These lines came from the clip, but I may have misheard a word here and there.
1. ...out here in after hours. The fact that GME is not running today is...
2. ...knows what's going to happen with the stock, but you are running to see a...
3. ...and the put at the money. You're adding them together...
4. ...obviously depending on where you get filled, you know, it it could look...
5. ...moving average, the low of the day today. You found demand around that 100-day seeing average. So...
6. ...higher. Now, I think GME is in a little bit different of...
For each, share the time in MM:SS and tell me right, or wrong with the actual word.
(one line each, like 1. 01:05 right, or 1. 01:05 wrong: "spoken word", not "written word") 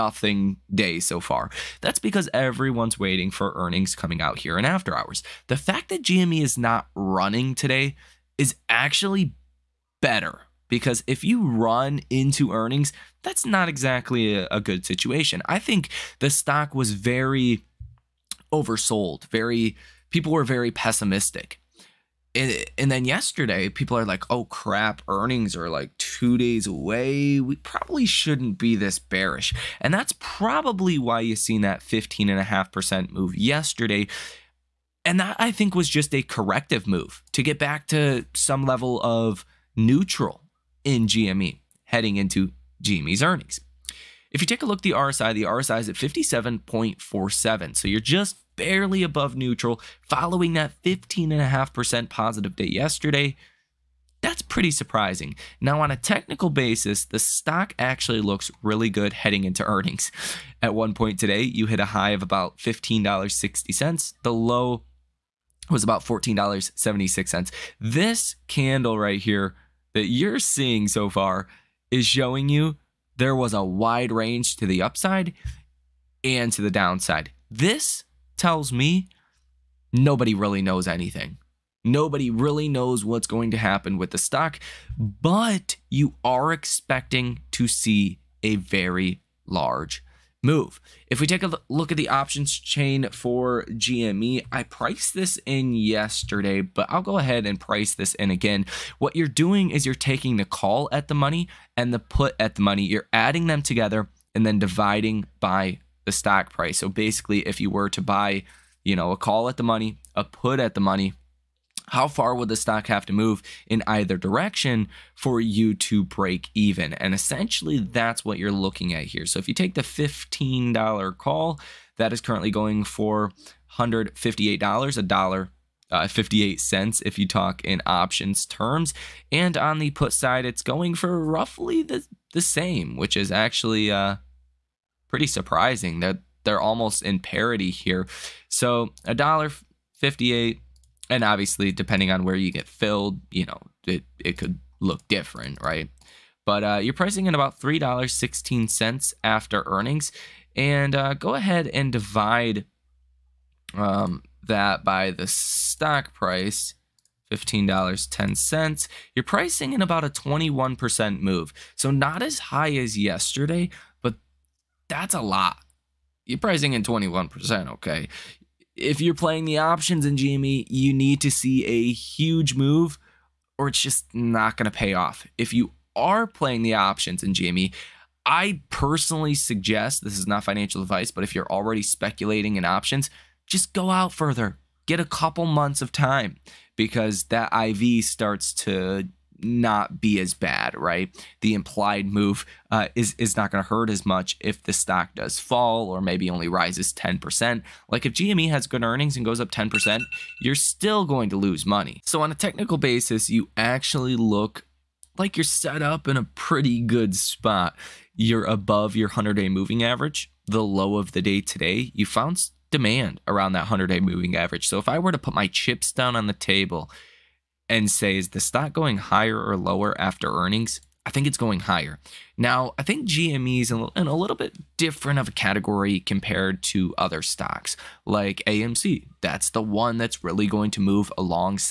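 1. 00:04 right
2. 01:22 wrong: "expecting", not "running"
3. 01:41 right
4. 02:21 right
5. 03:29 wrong: "moving", not "seeing"
6. 03:41 right.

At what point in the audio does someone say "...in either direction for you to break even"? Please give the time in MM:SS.
01:53.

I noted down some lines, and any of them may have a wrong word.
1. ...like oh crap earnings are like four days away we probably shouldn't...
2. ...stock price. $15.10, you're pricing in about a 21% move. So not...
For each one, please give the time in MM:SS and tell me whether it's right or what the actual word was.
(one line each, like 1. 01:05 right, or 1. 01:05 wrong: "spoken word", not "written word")
1. 00:24 wrong: "two", not "four"
2. 02:35 right.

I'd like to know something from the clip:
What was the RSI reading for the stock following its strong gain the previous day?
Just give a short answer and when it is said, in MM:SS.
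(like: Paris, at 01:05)
57.47, at 00:45.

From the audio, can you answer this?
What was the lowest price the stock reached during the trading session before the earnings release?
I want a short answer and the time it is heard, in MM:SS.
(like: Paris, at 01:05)
$14.76, at 01:06.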